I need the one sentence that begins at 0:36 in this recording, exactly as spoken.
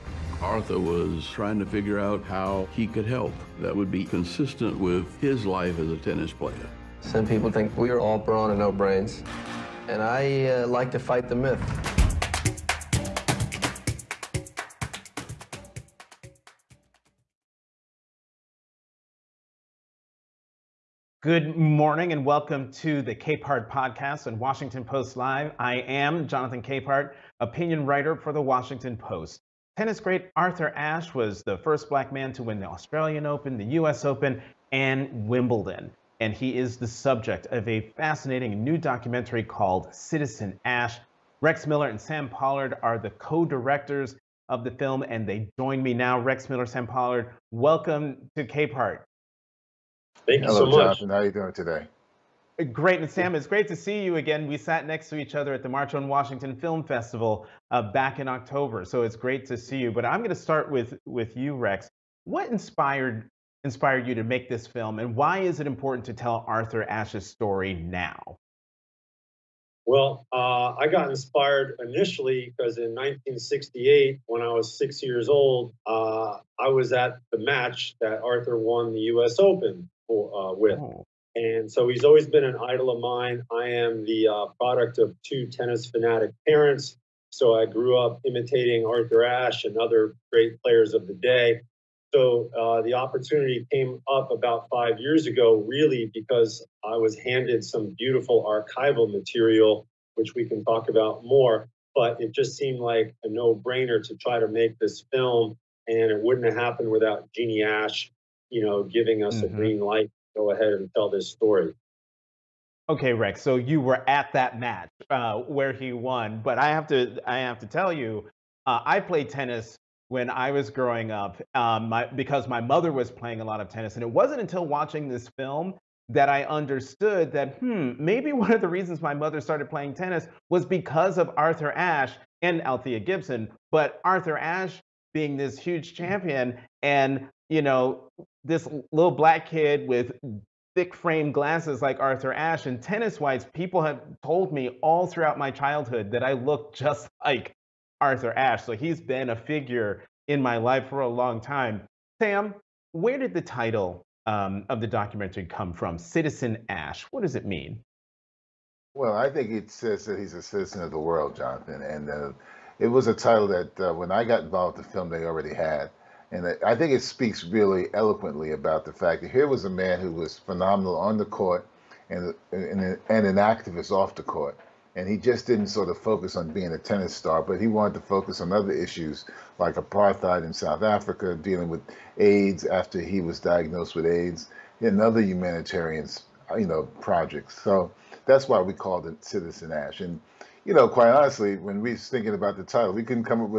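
And he is the subject of a fascinating new documentary called Citizen Ashe.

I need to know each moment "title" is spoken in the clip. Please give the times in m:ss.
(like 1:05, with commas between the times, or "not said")
2:33, 2:43, 3:12.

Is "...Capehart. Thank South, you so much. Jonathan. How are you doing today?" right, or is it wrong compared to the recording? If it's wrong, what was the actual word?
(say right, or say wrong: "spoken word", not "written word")
wrong: "Hello", not "South".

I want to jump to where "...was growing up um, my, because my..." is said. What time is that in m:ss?
2:00.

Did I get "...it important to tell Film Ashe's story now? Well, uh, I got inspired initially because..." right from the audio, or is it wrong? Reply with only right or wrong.
wrong.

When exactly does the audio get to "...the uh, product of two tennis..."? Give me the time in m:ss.
1:24.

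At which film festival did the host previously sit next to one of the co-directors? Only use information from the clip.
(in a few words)
March on Washington Film Festival.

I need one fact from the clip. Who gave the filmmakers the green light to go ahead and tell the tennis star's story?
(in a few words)
Jeannie Ashe.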